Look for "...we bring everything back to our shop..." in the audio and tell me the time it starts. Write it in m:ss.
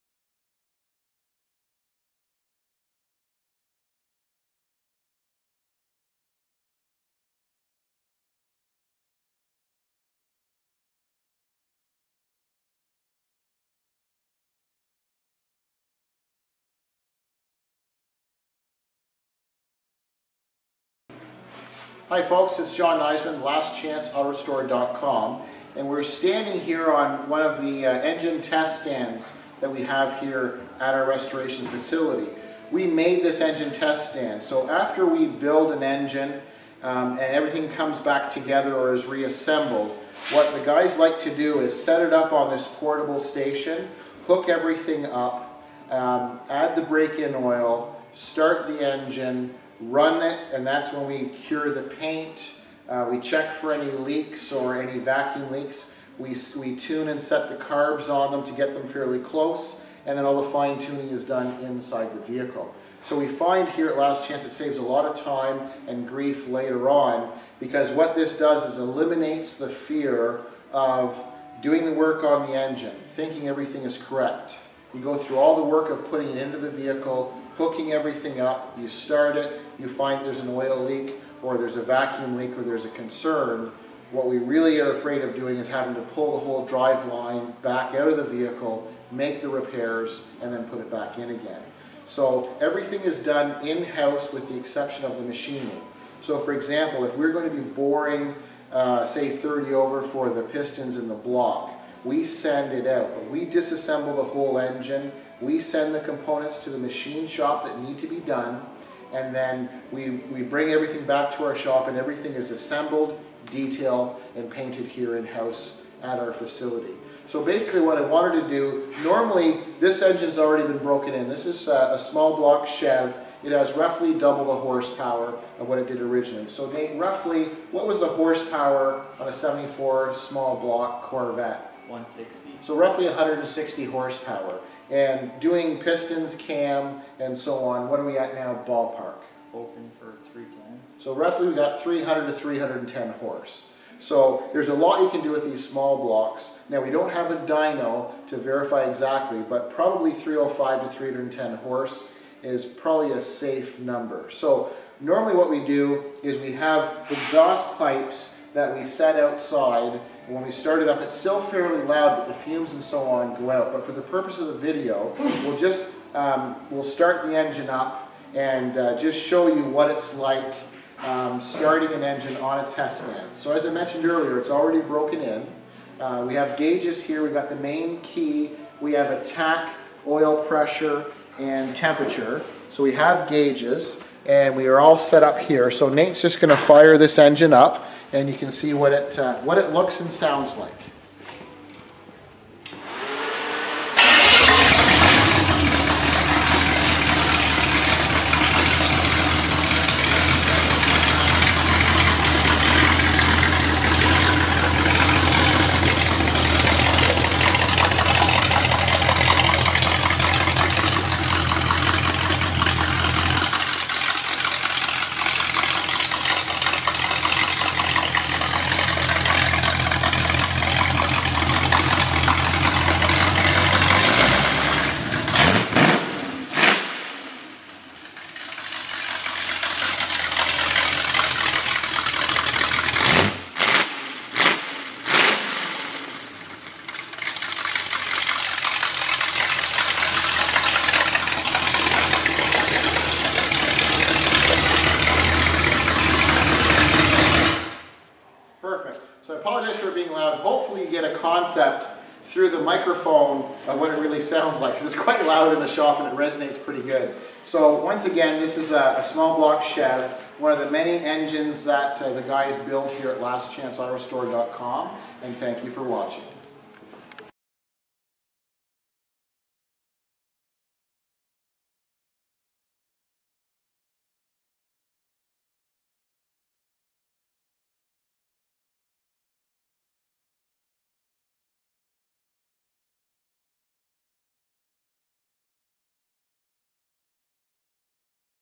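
1:50.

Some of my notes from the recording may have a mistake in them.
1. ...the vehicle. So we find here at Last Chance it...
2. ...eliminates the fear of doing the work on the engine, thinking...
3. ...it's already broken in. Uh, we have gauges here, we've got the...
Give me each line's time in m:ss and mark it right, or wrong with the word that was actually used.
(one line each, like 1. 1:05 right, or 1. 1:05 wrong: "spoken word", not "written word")
1. 1:02 right
2. 1:08 right
3. 2:54 right.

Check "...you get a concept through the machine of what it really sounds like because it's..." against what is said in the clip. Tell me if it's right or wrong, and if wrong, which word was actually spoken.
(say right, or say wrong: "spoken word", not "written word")
wrong: "microphone", not "machine".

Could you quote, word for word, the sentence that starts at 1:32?
So everything is done in-house with the exception of the machining.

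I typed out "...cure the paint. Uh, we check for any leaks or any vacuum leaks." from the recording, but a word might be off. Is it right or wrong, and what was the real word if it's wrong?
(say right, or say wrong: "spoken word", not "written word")
right.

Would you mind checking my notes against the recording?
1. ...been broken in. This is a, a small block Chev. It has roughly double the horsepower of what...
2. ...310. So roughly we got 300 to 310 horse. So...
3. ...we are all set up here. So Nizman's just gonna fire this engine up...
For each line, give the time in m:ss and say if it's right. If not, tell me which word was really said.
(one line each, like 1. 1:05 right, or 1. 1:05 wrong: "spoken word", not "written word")
1. 2:00 right
2. 2:20 right
3. 3:04 wrong: "Nate", not "Nizman".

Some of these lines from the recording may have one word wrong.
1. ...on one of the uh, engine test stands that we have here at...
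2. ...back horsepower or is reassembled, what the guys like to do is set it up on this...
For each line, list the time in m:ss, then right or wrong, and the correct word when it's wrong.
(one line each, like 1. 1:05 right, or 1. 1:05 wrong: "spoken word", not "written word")
1. 0:26 right
2. 0:38 wrong: "together", not "horsepower".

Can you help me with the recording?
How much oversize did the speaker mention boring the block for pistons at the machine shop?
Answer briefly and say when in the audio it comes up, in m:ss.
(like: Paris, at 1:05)
30 over, at 1:39.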